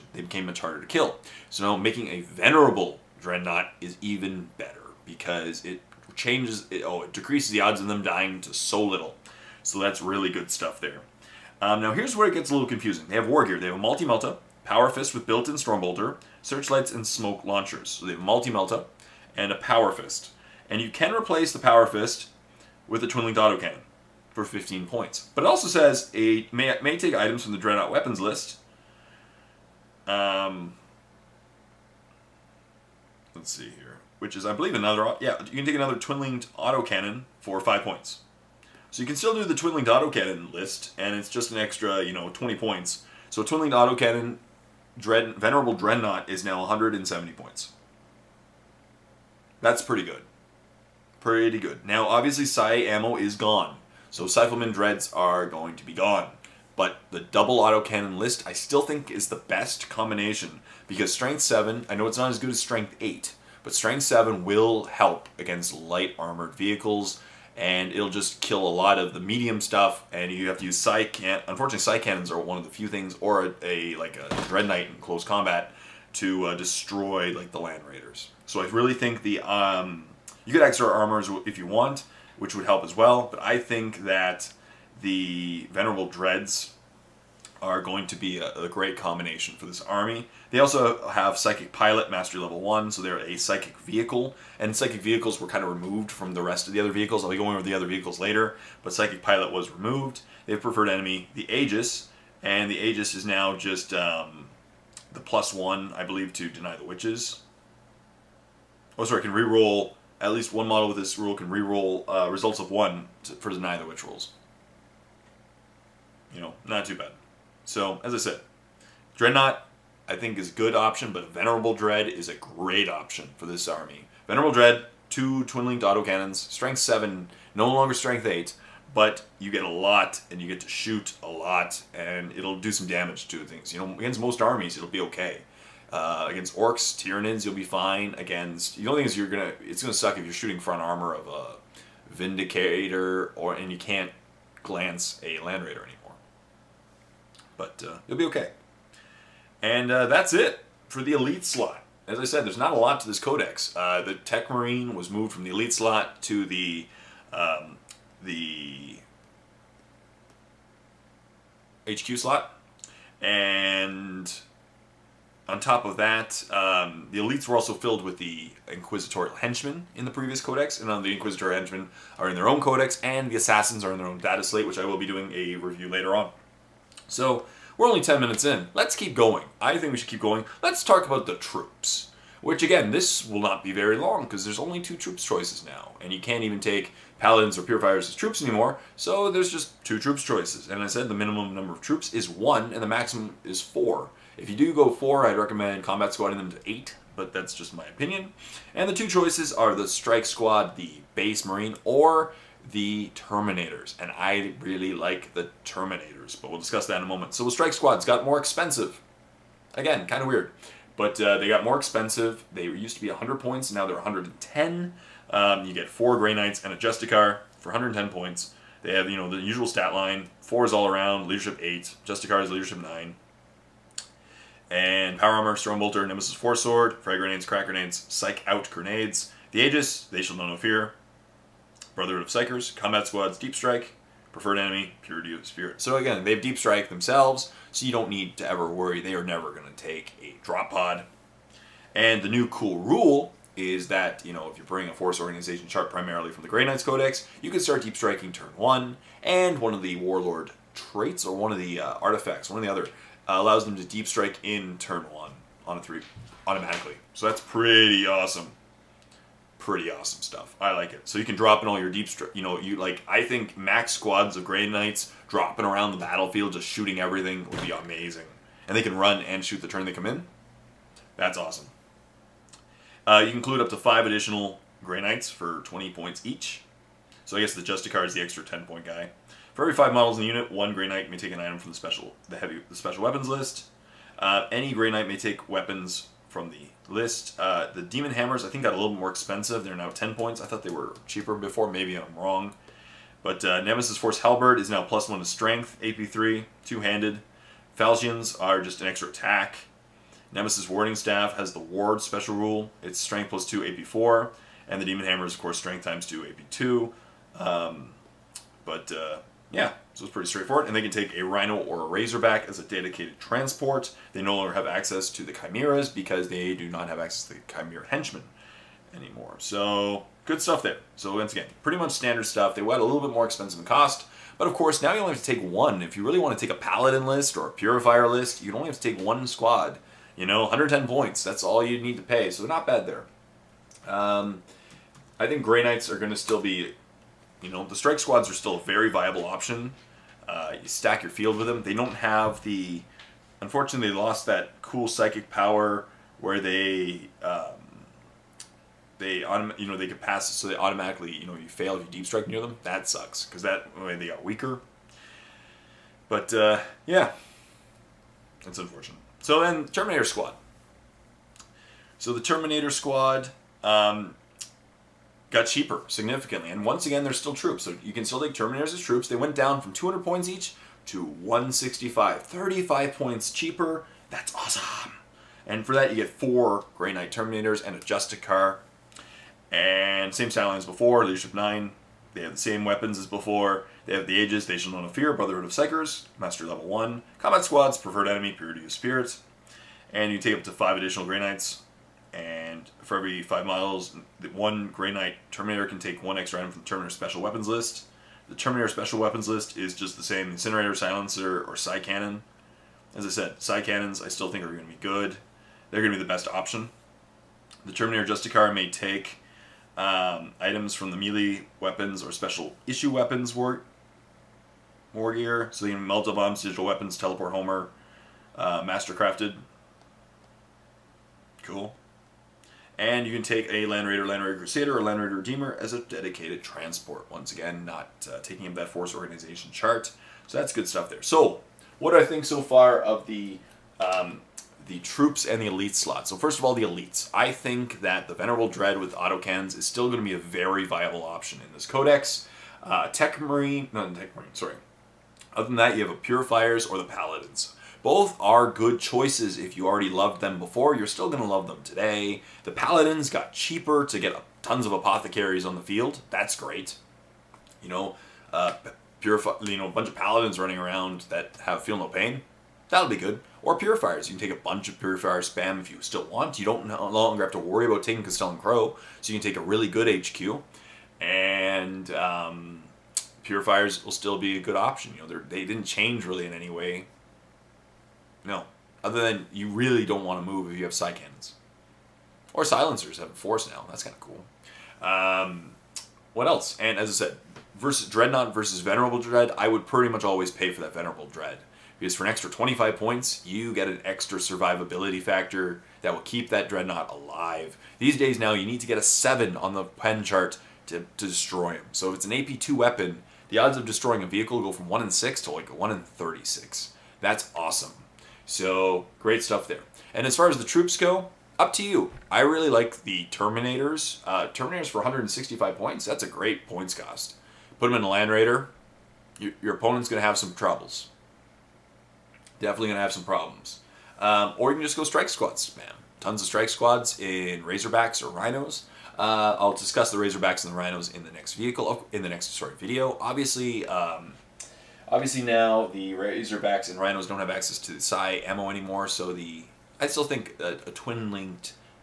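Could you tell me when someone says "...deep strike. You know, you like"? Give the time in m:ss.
4:21.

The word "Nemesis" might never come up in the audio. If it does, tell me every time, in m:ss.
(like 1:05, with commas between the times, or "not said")
3:46, 4:53, 5:00.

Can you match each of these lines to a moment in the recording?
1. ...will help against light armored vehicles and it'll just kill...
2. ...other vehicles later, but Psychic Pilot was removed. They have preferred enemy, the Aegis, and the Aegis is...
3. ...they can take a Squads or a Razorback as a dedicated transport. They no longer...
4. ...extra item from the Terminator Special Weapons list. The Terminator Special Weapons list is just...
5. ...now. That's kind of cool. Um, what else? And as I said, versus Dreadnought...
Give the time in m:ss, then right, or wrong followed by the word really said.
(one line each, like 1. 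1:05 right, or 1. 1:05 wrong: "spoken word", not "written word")
1. 1:04 right
2. 1:37 right
3. 5:10 wrong: "Rhino", not "Squads"
4. 6:36 right
5. 8:03 right.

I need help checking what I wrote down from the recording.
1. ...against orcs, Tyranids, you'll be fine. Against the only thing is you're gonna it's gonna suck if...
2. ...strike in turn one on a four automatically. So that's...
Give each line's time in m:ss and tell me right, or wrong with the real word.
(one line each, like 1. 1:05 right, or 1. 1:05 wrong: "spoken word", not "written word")
1. 2:16 right
2. 4:14 wrong: "three", not "four".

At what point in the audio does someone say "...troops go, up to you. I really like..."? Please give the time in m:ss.
8:30.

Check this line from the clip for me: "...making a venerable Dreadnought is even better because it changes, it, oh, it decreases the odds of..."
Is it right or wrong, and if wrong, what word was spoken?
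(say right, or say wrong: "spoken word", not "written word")
right.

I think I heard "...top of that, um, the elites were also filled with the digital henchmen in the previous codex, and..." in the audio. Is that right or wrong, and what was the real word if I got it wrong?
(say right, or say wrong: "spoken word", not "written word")
wrong: "inquisitorial", not "digital".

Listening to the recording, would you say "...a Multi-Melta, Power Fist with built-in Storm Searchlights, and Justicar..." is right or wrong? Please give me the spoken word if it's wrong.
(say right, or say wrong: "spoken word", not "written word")
wrong: "Smoke", not "Justicar".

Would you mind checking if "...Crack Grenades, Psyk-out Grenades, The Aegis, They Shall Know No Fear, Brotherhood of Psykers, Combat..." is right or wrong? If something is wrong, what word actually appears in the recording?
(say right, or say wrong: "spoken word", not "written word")
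right.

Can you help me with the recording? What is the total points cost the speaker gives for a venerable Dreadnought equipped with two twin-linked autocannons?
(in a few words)
170 points.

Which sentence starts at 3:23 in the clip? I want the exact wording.
And I really like the Terminators, but we'll discuss that in a moment.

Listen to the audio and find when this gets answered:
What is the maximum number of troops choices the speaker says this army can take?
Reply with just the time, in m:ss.
3:12.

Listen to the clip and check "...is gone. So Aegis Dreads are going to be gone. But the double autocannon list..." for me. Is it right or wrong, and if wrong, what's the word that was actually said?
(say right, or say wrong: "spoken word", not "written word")
wrong: "Psyfleman", not "Aegis".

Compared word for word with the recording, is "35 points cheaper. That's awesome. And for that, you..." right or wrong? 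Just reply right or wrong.
right.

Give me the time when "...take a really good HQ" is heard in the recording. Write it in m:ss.
7:49.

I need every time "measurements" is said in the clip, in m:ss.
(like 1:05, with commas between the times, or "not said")
not said.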